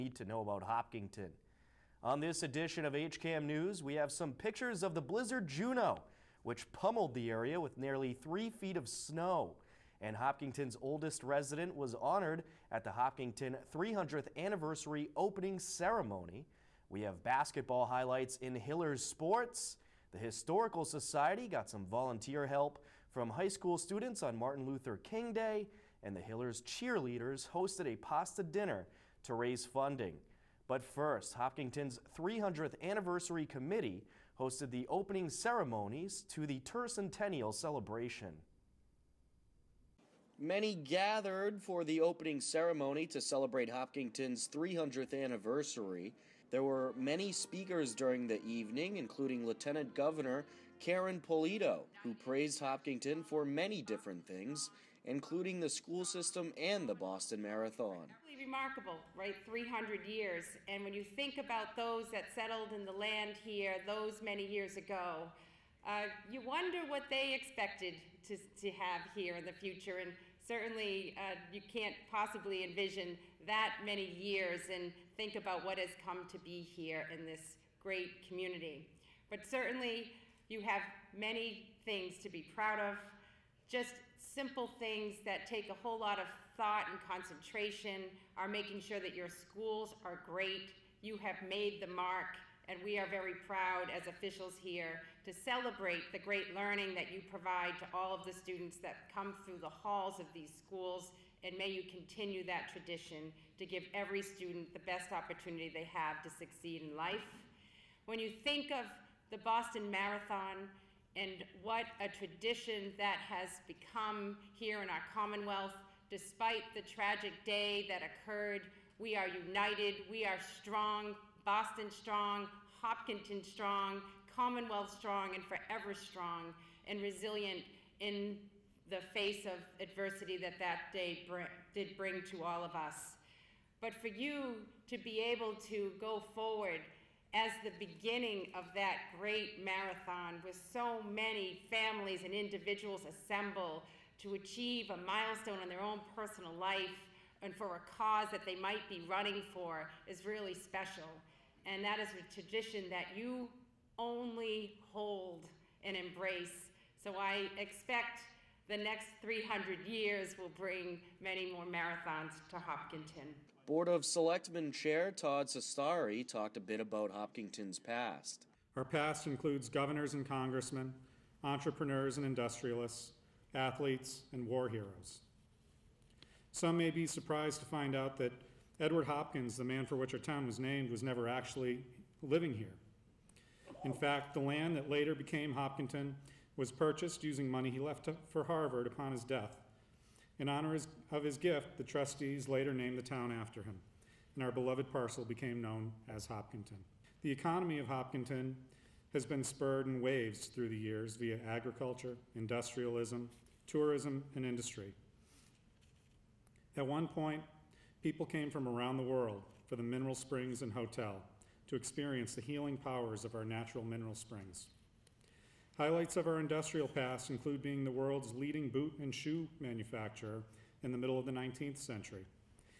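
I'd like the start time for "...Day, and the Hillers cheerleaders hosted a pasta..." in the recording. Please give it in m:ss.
0:25.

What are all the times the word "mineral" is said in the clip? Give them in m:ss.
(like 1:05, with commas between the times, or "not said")
3:29, 3:33.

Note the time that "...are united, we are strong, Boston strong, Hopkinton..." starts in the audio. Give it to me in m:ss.
1:59.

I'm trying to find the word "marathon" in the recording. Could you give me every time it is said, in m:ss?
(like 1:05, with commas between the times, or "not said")
0:57, 1:49, 2:19, 2:41.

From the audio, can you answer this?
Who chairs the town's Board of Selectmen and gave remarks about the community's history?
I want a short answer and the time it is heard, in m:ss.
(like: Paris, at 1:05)
Todd Cestari, at 2:45.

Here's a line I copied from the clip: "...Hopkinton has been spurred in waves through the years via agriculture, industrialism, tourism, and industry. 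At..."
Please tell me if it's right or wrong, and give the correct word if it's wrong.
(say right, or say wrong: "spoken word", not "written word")
right.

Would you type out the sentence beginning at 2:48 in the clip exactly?
Our past includes governors and congressmen, entrepreneurs and industrialists, athletes, and war heroes.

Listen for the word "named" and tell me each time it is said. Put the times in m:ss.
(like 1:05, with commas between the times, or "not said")
3:00, 3:12.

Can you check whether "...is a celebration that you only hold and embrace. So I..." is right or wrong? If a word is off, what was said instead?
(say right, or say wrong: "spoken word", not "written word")
wrong: "tradition", not "celebration".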